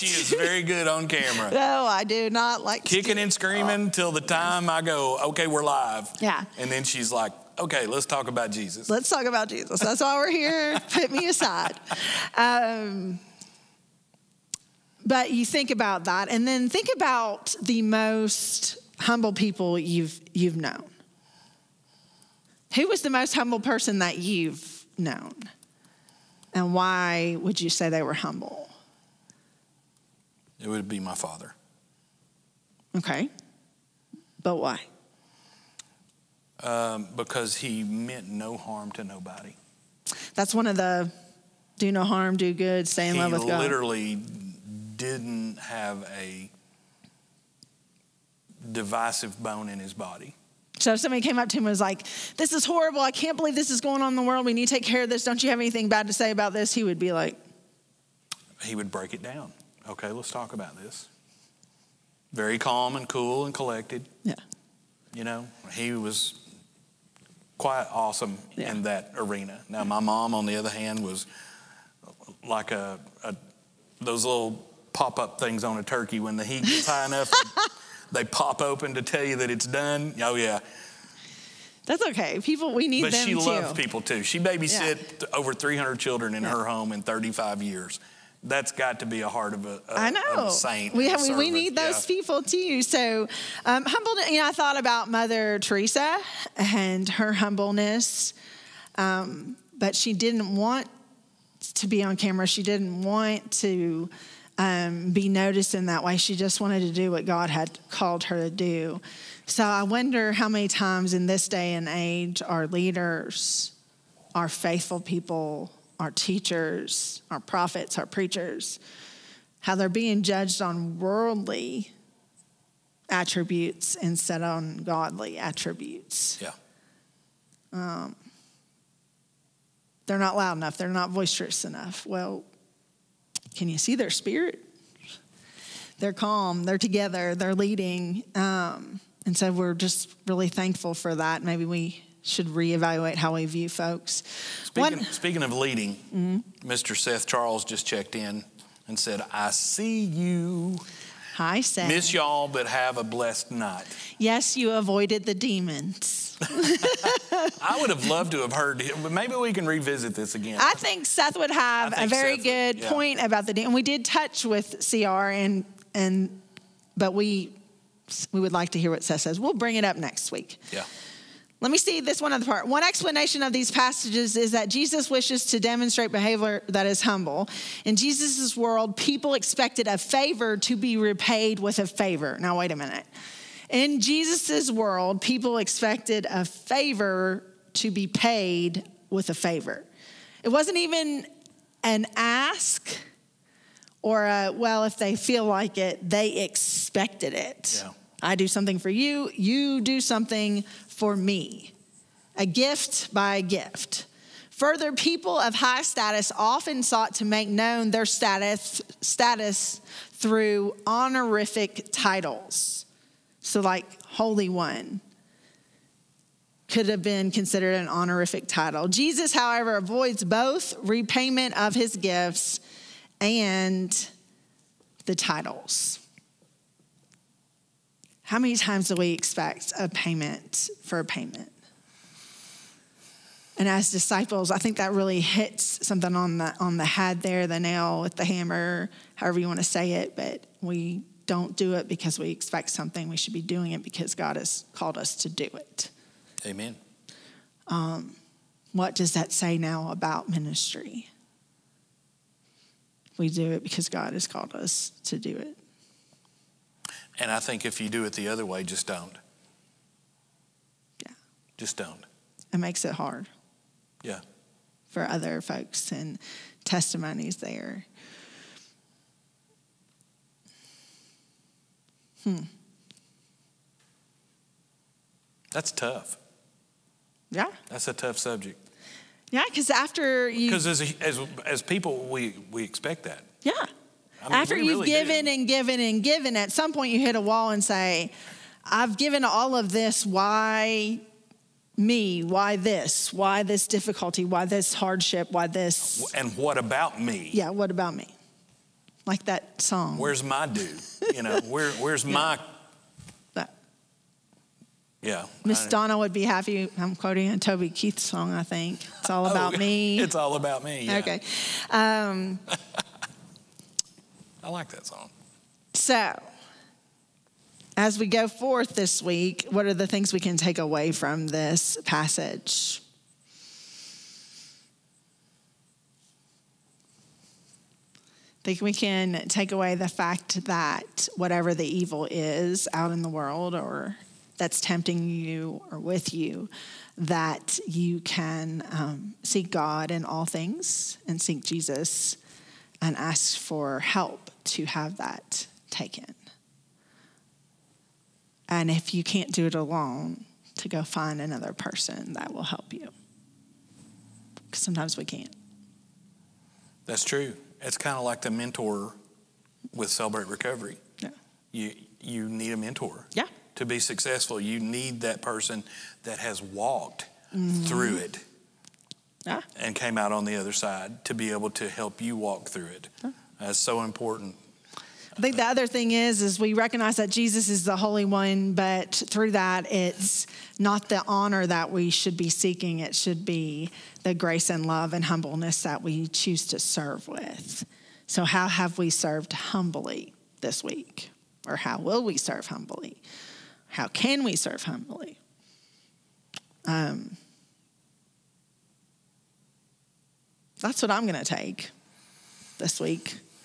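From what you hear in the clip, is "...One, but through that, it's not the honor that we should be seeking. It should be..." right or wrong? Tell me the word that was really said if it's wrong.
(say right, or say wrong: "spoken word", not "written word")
right.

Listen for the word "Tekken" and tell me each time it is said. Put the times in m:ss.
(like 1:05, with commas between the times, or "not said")
not said.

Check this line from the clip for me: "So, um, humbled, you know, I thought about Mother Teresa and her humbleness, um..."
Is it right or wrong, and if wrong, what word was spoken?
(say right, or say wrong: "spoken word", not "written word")
right.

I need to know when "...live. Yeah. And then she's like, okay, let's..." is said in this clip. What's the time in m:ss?
0:05.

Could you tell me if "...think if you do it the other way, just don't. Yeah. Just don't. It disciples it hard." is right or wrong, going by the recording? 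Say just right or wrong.
wrong.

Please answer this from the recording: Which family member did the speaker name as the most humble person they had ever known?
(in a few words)
Father.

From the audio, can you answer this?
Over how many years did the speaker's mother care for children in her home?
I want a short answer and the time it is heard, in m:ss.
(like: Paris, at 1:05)
35, at 1:27.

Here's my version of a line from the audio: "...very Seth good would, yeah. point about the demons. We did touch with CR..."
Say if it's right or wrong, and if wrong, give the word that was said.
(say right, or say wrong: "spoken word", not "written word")
right.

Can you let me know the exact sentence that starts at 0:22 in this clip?
Who was the most humble person that you've known?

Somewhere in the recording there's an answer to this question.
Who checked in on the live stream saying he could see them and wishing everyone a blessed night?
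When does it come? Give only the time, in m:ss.
2:26.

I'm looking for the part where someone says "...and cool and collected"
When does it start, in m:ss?
1:02.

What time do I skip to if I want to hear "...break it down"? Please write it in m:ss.
0:58.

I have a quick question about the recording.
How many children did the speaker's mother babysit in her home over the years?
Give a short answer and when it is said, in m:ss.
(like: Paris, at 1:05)
300, at 1:25.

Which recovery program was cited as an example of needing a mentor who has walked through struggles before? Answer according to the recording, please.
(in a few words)
Celebrate Recovery.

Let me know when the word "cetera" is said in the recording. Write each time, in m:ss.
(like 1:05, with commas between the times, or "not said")
not said.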